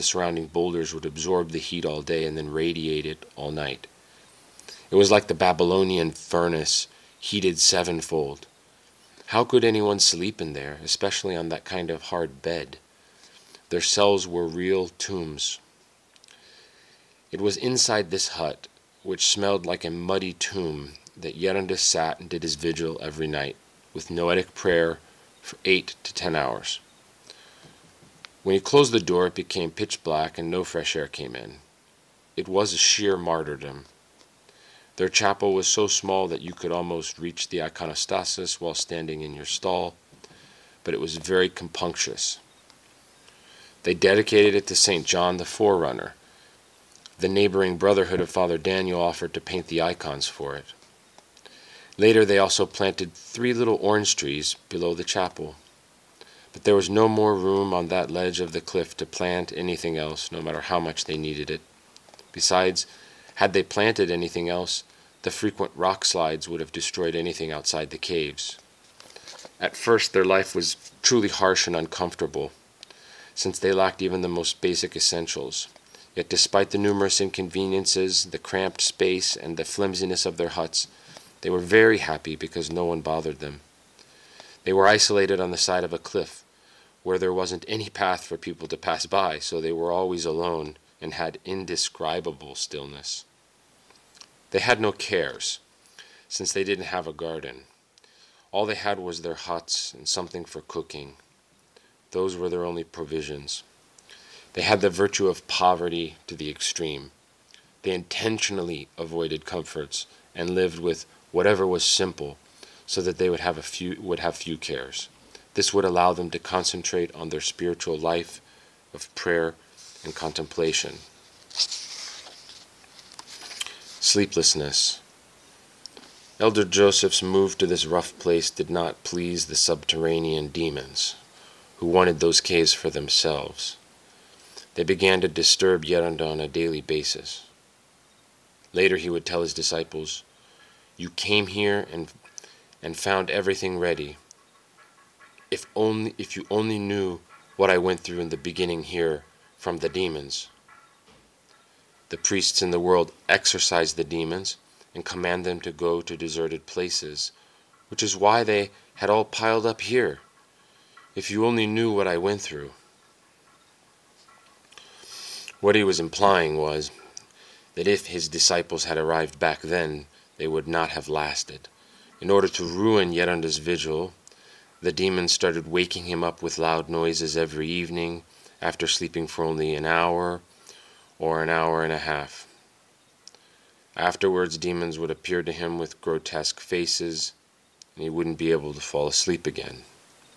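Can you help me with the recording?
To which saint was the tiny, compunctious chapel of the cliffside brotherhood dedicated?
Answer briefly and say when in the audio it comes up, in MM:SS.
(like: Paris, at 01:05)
St. John the Forerunner, at 00:44.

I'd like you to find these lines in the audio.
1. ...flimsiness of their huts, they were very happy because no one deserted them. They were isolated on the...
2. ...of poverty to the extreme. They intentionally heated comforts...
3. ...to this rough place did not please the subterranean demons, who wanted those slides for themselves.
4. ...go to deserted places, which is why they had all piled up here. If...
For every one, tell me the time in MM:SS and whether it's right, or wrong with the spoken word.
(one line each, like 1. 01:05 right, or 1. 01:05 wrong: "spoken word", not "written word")
1. 01:19 wrong: "bothered", not "deserted"
2. 01:45 wrong: "avoided", not "heated"
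3. 02:07 wrong: "caves", not "slides"
4. 02:35 right.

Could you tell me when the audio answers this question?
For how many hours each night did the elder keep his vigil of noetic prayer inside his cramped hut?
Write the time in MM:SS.
00:25.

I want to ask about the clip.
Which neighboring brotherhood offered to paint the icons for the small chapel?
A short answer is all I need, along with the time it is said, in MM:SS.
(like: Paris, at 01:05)
Father Daniel's, at 00:48.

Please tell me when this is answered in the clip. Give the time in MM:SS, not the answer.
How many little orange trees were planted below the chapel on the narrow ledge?
00:53.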